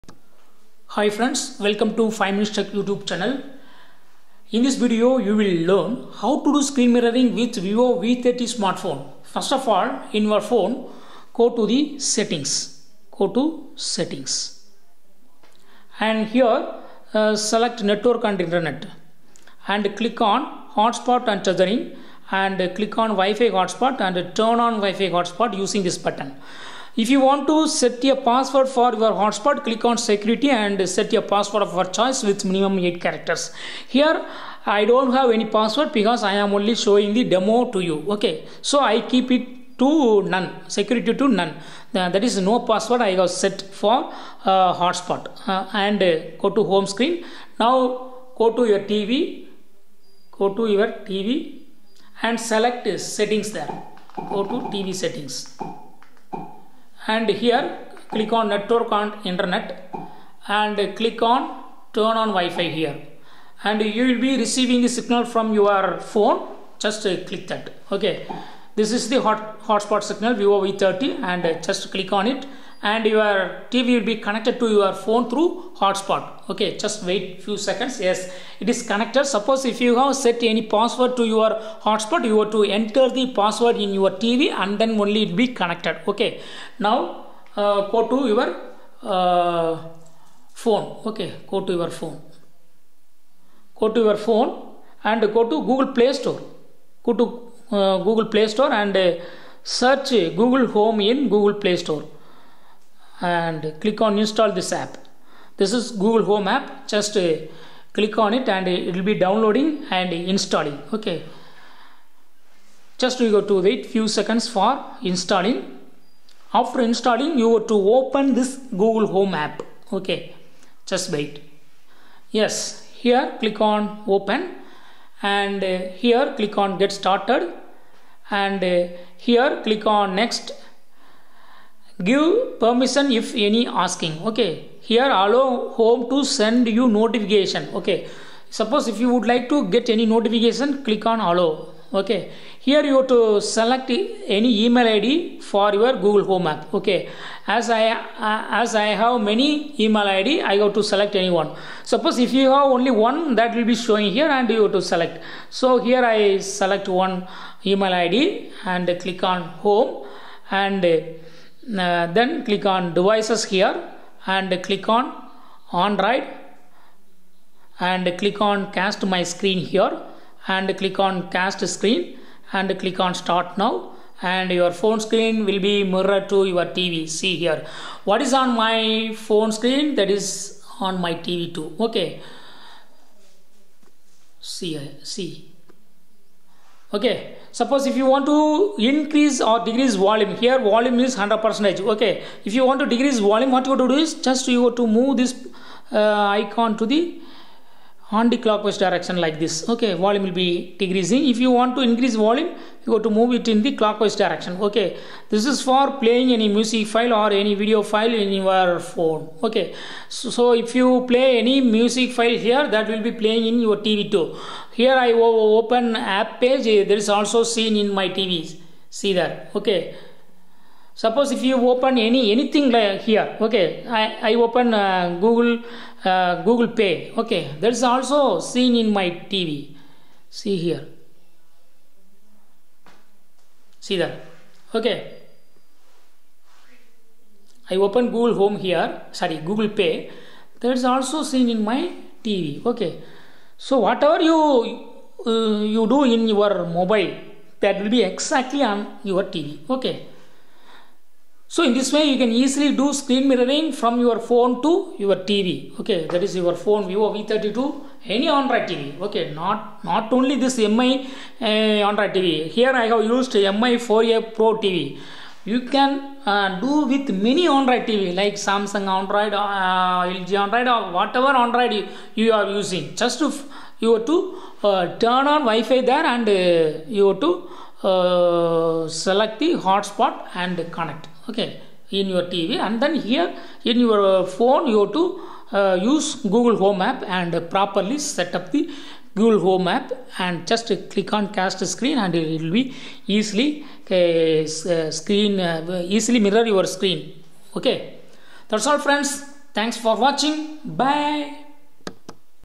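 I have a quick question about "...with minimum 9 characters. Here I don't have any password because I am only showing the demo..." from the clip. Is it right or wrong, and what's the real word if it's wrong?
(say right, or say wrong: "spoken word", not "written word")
wrong: "8", not "9".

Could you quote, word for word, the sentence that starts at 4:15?
Okay, that is your phone Vivo V32, any Android TV.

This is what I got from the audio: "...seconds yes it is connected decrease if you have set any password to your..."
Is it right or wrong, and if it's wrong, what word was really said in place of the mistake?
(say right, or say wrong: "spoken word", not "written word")
wrong: "suppose", not "decrease".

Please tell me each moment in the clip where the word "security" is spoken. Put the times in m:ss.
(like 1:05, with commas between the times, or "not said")
0:29, 0:40.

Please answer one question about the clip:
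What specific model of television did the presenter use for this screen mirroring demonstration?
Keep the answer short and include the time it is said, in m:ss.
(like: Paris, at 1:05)
MI 4A Pro, at 4:23.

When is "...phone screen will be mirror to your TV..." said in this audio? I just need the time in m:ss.
2:54.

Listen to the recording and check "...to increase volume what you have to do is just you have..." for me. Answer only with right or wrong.
wrong.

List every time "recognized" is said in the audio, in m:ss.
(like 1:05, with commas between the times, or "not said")
not said.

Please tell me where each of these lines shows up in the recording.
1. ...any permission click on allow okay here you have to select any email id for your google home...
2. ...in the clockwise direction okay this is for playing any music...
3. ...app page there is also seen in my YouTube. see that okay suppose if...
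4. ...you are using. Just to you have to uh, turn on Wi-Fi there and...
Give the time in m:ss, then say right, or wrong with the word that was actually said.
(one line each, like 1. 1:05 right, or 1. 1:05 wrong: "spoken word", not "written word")
1. 2:19 wrong: "notification", not "permission"
2. 3:23 right
3. 3:35 wrong: "TVs", not "YouTube"
4. 4:32 right.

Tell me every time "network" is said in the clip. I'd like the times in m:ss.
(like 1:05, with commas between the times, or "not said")
0:17, 0:58.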